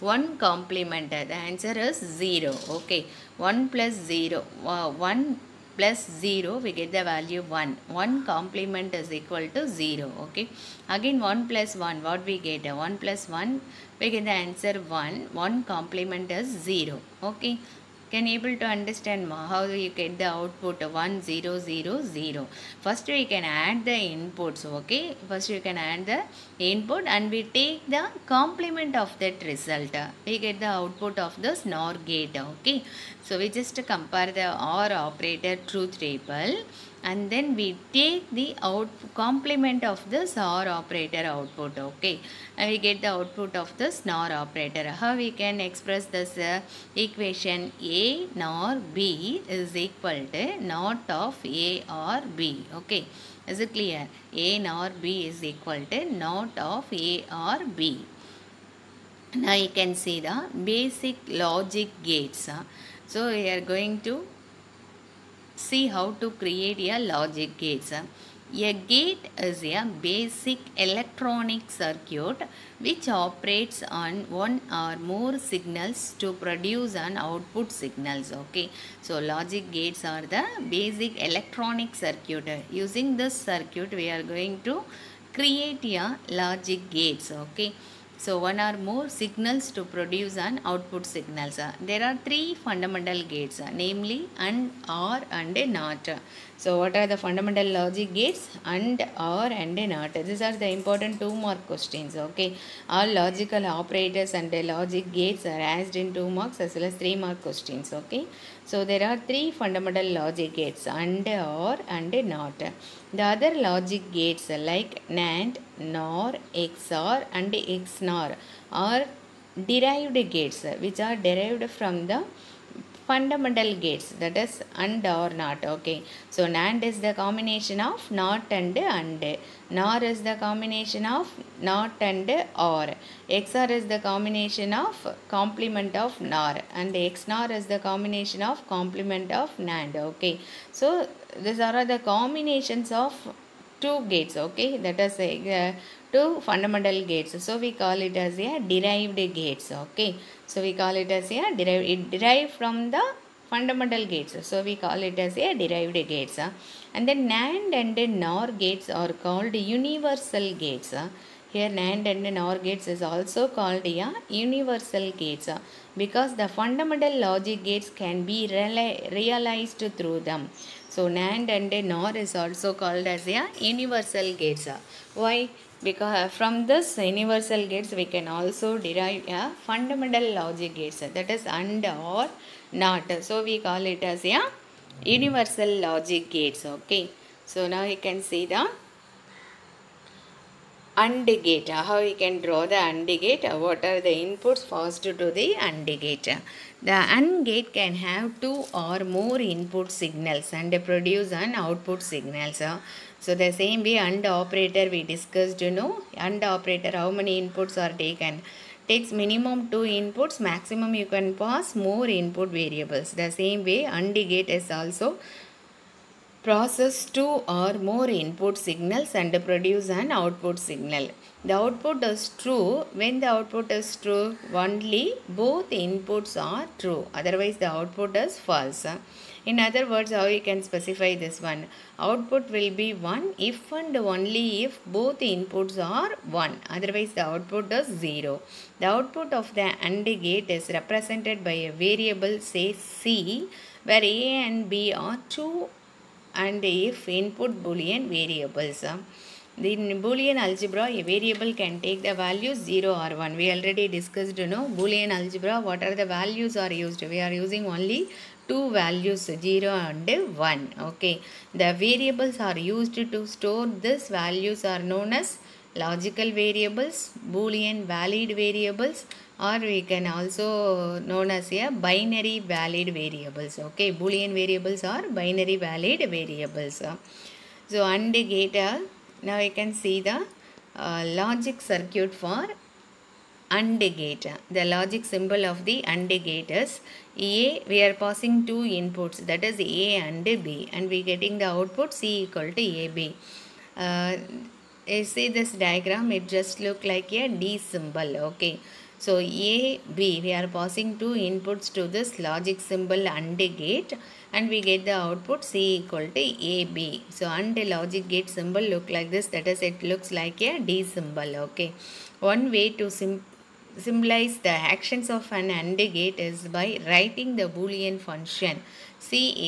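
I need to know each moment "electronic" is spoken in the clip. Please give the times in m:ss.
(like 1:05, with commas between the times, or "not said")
1:10, 1:21.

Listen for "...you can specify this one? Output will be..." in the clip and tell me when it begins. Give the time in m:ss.
3:50.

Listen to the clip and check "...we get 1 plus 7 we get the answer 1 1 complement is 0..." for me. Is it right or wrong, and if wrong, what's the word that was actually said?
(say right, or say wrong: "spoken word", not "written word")
wrong: "1", not "7".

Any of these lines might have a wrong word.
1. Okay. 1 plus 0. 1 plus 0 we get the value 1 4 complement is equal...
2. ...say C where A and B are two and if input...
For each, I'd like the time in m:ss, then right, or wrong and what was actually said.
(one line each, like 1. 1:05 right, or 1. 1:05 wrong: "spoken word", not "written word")
1. 0:02 wrong: "1", not "4"
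2. 4:02 right.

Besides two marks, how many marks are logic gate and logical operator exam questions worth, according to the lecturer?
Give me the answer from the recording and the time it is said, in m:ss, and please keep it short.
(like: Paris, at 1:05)
3, at 1:46.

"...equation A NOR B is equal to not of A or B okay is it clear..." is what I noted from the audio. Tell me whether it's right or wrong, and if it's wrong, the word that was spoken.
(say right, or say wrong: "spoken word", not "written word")
right.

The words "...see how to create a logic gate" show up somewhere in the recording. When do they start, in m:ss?
1:05.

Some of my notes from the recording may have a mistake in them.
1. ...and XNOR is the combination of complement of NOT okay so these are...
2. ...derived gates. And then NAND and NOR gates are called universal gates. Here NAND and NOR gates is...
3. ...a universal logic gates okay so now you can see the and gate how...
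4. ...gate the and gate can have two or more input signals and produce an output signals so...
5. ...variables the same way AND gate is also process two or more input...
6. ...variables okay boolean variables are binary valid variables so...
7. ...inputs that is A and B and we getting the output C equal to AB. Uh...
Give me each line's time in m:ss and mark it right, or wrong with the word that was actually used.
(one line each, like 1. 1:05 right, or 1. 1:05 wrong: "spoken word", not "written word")
1. 2:16 wrong: "NAND", not "NOT"
2. 2:35 right
3. 3:04 right
4. 3:15 right
5. 3:32 right
6. 4:33 right
7. 4:48 right.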